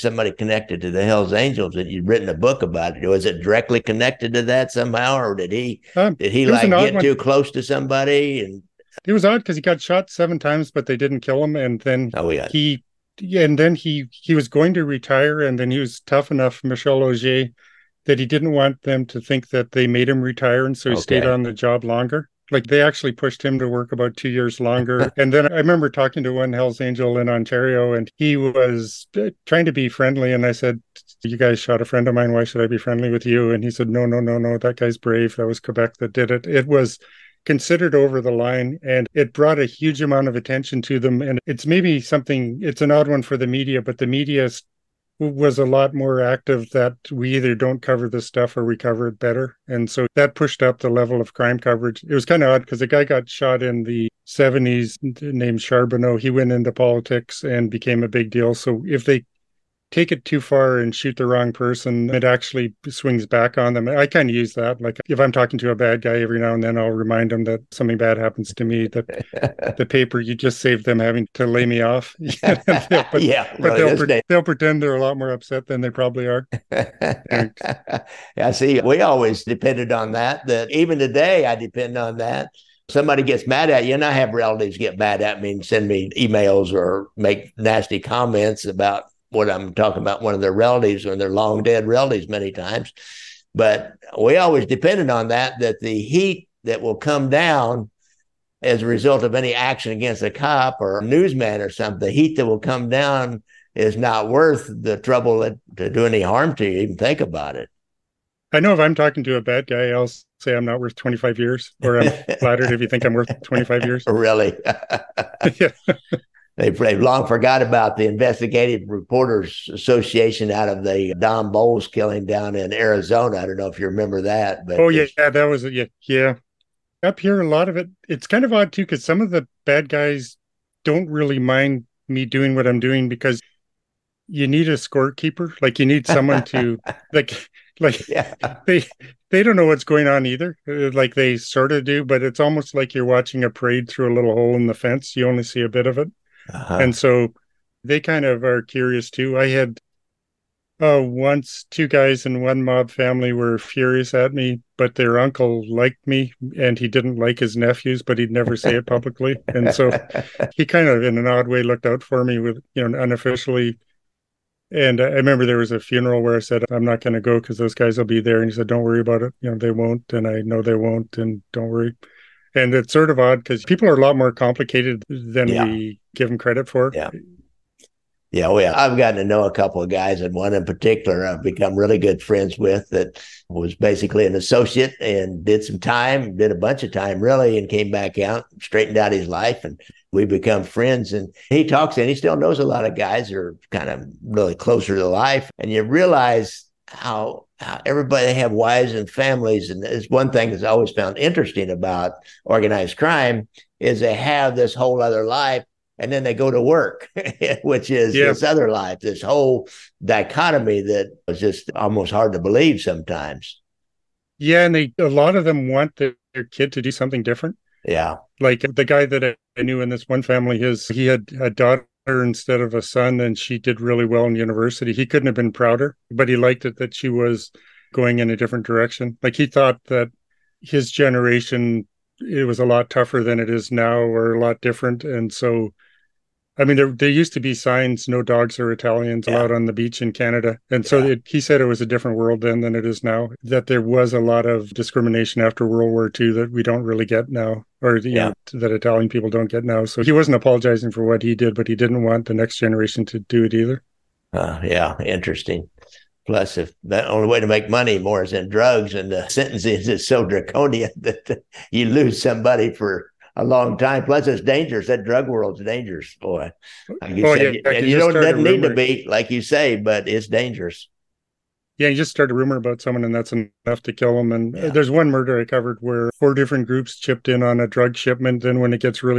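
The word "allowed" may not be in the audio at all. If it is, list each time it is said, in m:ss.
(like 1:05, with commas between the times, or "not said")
3:59.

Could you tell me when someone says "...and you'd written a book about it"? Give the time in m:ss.
0:01.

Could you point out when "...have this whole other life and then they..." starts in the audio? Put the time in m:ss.
3:24.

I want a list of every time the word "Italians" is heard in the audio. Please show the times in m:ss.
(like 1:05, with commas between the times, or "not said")
3:58, 4:08.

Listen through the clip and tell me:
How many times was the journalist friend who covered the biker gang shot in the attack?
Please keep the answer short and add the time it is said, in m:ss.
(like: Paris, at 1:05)
7, at 0:10.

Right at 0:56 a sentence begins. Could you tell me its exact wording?
He went into politics and became a big deal.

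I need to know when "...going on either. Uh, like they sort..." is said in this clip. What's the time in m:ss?
2:19.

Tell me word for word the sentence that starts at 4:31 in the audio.
Yeah, you just start a rumor about someone, and that's enough to kill them.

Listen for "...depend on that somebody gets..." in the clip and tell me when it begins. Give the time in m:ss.
1:21.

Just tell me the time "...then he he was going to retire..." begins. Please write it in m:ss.
0:13.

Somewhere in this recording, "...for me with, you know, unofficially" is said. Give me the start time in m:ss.
2:42.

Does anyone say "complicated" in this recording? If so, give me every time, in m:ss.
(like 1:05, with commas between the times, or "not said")
2:54.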